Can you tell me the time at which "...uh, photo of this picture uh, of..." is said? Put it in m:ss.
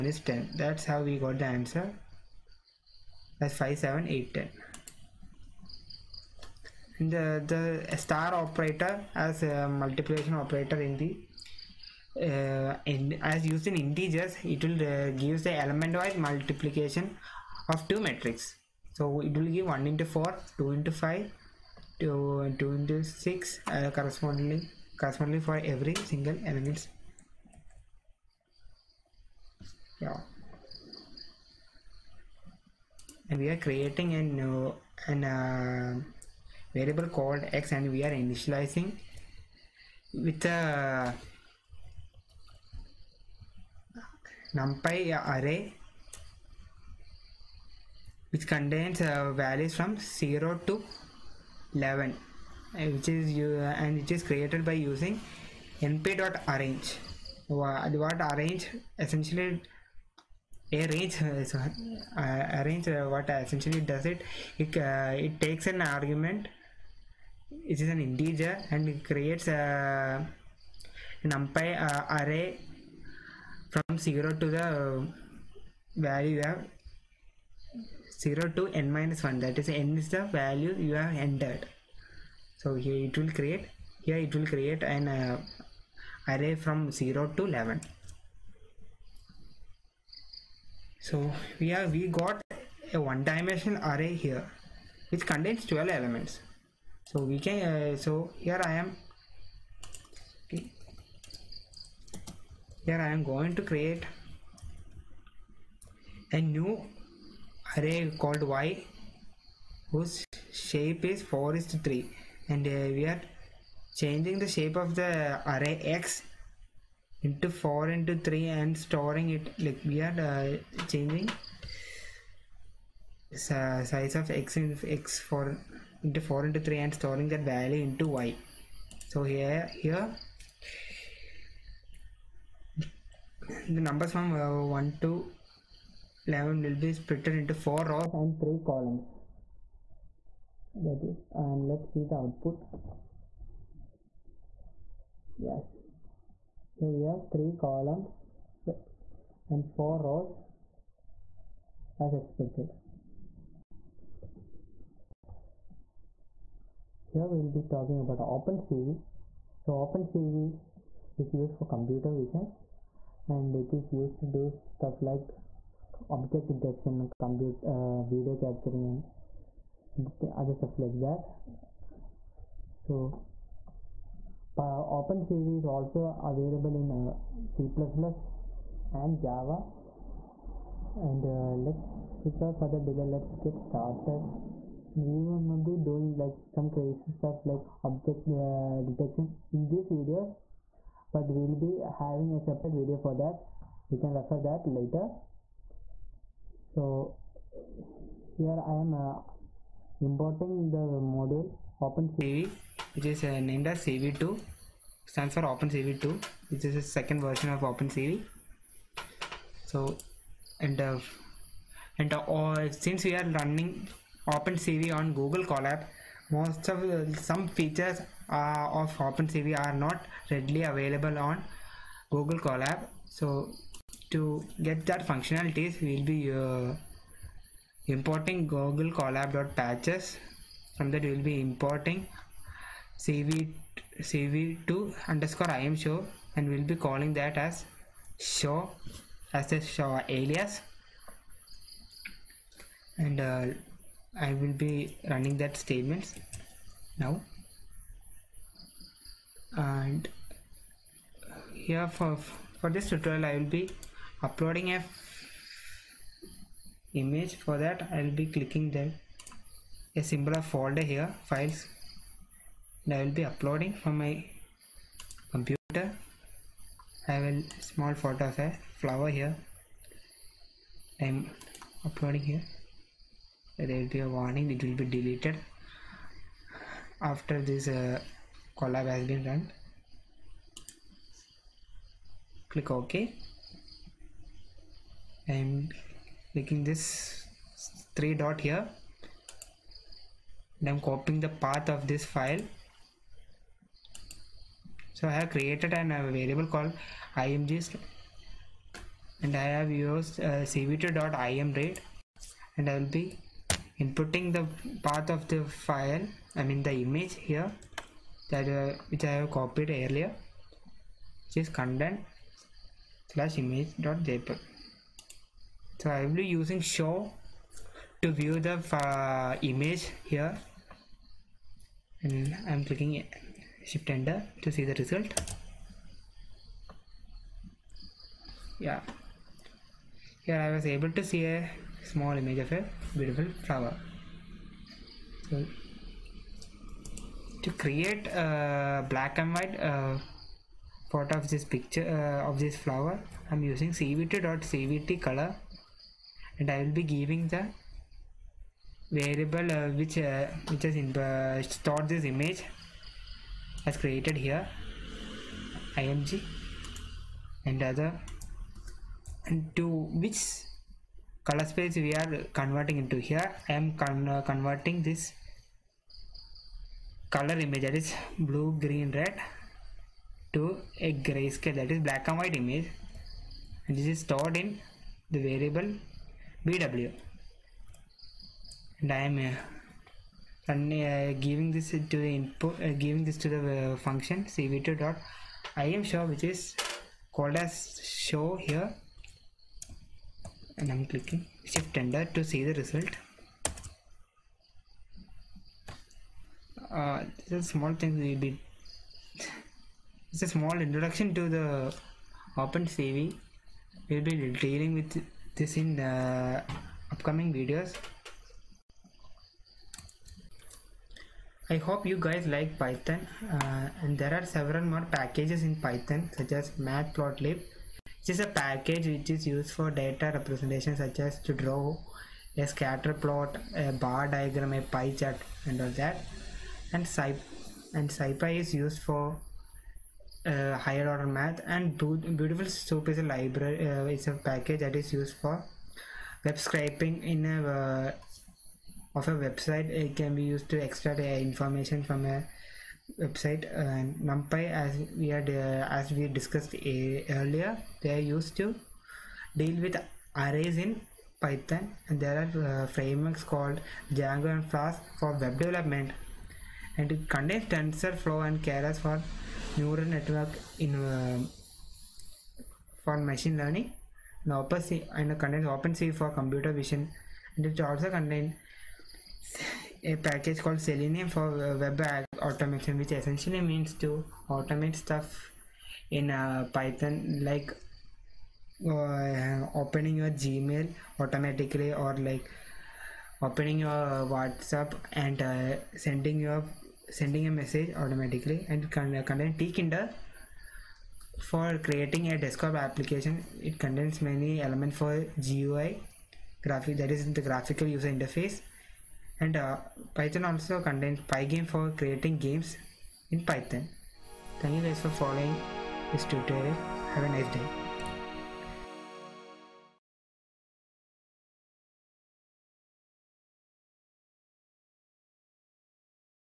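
5:39.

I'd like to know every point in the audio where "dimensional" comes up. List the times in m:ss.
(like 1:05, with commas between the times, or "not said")
1:33.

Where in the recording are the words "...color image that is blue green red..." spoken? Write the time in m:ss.
6:07.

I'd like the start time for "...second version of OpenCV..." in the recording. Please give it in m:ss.
3:26.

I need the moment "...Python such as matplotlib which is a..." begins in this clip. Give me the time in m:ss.
6:55.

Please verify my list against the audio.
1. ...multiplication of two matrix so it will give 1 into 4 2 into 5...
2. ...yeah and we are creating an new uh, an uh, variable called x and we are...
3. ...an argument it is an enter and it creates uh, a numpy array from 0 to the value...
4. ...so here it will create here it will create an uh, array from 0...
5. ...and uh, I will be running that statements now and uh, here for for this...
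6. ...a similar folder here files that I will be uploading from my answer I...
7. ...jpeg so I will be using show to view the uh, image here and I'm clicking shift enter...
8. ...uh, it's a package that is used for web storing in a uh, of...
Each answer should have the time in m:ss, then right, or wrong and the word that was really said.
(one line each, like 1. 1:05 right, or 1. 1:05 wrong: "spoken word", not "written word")
1. 0:16 right
2. 0:30 right
3. 1:05 wrong: "integer", not "enter"
4. 1:22 right
5. 4:02 right
6. 4:19 wrong: "computer", not "answer"
7. 5:14 right
8. 7:13 wrong: "scraping", not "storing".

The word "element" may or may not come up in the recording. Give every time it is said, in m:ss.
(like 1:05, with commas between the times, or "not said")
0:15, 0:26, 1:35, 8:14.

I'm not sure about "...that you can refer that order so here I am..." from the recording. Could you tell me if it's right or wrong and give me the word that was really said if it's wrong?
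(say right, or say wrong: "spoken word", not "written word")
wrong: "later", not "order".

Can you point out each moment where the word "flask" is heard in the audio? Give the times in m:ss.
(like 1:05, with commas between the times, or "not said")
7:34.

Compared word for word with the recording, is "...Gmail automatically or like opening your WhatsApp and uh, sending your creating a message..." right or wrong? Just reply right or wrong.
wrong.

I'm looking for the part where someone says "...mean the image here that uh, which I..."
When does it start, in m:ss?
5:06.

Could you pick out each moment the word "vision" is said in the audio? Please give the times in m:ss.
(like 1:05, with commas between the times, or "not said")
2:42, 7:46.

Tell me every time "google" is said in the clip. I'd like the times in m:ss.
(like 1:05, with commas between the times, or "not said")
3:35, 3:42, 3:48.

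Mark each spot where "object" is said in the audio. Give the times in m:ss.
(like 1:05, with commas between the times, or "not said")
2:46, 3:07.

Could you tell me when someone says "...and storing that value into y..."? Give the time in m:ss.
2:06.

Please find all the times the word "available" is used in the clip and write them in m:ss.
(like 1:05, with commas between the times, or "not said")
2:56, 3:40.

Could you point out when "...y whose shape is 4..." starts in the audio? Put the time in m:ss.
1:48.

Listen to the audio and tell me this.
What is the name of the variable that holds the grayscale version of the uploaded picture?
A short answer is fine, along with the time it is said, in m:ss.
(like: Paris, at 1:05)
VW, at 6:16.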